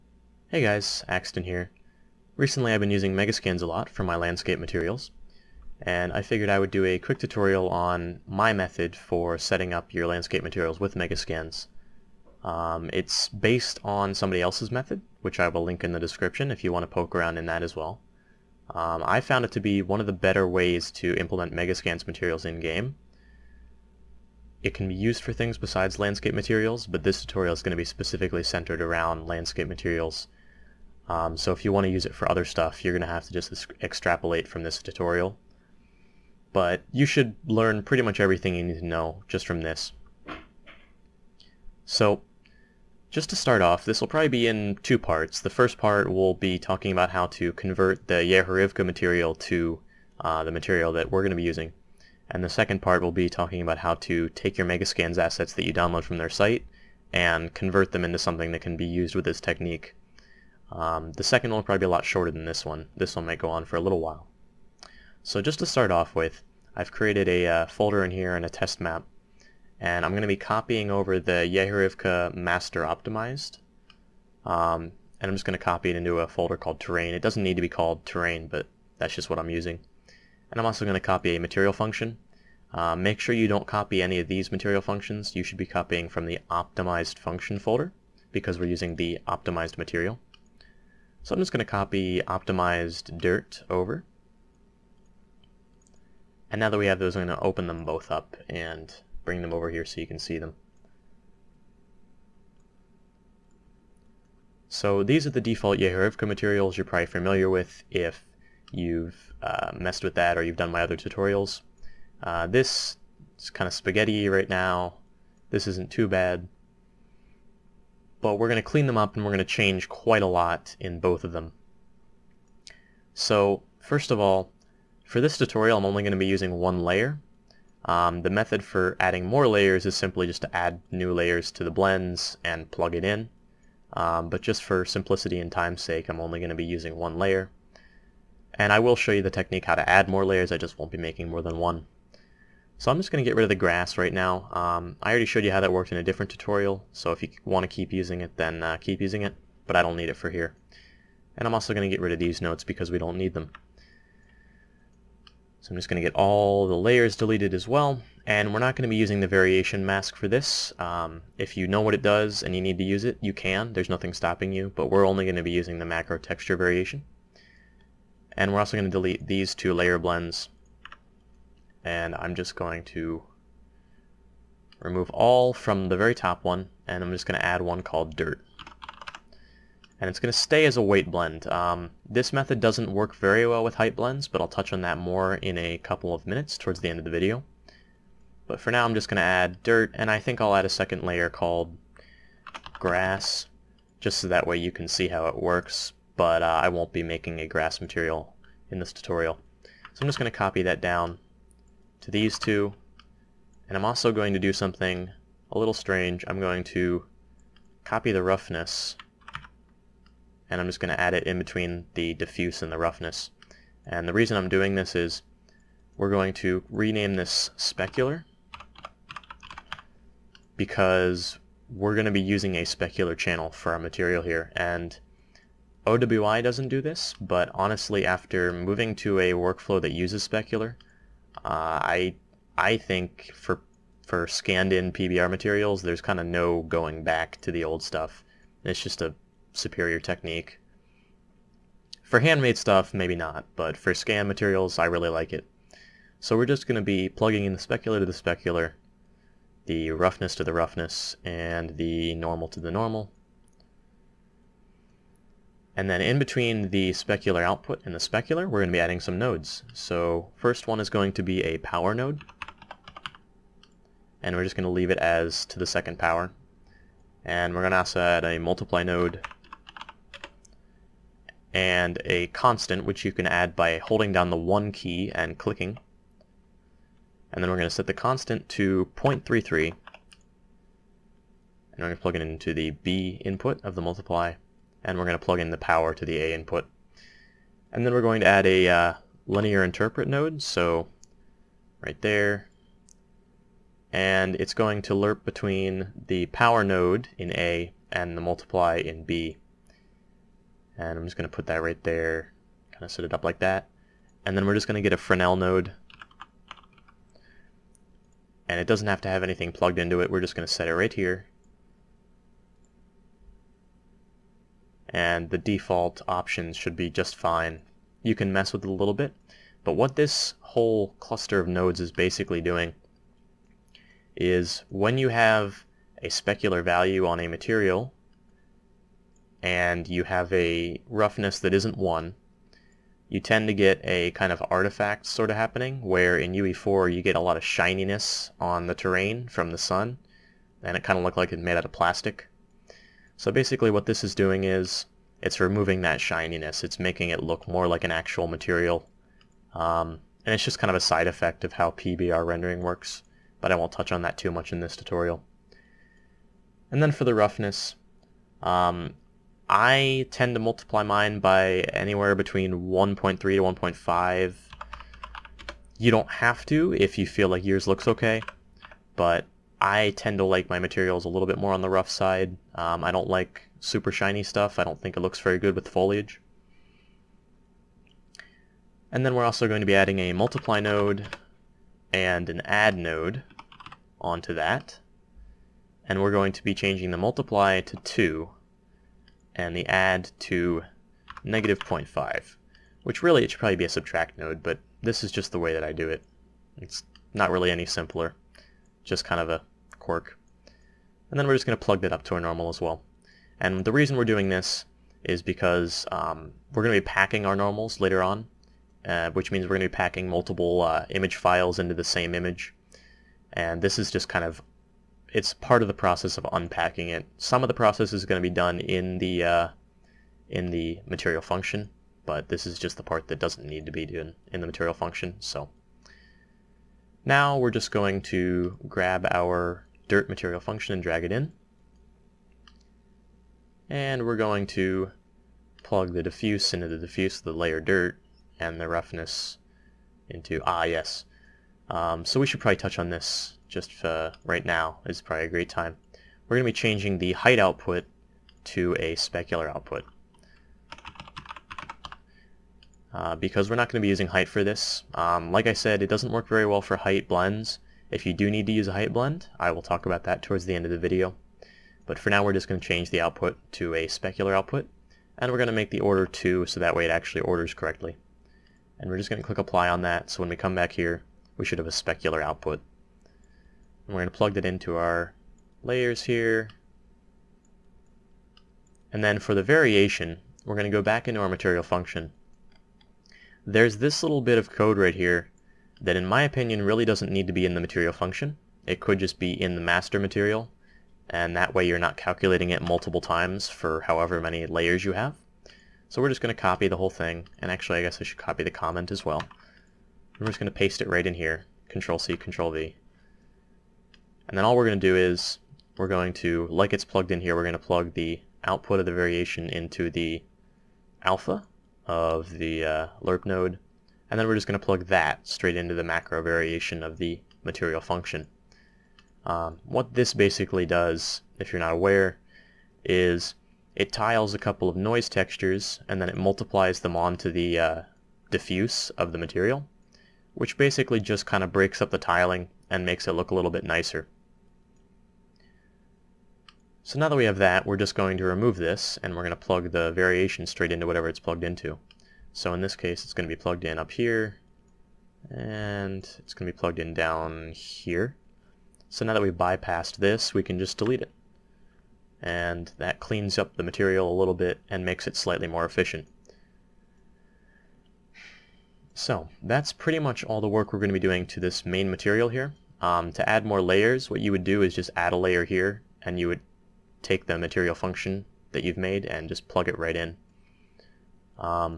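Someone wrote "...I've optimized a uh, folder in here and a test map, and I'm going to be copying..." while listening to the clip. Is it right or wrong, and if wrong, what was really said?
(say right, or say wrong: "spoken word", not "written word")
wrong: "created", not "optimized".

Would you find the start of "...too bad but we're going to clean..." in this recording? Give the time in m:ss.
1:55.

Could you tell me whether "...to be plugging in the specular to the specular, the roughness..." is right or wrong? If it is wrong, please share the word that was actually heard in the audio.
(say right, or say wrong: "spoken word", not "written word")
right.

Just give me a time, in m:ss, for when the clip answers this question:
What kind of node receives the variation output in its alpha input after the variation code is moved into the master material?
8:33.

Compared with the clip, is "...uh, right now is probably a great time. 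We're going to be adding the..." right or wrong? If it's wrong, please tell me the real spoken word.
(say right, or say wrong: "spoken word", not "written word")
wrong: "changing", not "adding".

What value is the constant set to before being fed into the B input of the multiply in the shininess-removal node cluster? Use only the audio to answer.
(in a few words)
0.33.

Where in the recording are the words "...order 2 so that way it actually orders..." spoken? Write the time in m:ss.
7:45.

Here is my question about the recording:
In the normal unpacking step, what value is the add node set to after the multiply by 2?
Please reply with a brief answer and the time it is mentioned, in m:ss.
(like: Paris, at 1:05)
-0.5, at 6:31.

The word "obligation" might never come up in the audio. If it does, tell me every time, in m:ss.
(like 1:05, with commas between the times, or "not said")
not said.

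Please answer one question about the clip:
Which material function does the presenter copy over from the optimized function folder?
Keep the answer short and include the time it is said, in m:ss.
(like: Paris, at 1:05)
optimized dirt, at 1:32.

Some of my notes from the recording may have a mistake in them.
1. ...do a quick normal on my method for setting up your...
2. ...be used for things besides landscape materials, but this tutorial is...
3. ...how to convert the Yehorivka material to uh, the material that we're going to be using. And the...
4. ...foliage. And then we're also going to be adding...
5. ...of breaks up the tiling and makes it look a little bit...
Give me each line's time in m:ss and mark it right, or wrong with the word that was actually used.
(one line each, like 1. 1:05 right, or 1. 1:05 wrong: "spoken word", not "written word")
1. 0:06 wrong: "tutorial", not "normal"
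2. 0:24 right
3. 0:47 right
4. 6:15 right
5. 8:51 right.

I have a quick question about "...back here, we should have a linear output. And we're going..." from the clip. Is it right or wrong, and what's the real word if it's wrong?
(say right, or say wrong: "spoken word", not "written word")
wrong: "specular", not "linear".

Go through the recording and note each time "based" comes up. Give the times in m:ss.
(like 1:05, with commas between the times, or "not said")
0:13.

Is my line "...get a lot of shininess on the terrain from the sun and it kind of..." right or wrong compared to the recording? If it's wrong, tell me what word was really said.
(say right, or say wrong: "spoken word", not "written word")
right.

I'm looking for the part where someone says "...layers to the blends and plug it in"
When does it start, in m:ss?
2:11.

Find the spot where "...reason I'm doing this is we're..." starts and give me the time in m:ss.
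3:34.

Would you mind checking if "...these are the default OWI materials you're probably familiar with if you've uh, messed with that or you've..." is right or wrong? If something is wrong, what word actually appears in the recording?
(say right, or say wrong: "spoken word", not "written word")
wrong: "Yehorivka", not "OWI".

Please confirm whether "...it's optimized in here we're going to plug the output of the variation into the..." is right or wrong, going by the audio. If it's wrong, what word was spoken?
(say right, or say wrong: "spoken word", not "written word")
wrong: "plugged", not "optimized".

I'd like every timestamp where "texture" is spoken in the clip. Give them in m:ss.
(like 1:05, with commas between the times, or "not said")
2:46, 8:45.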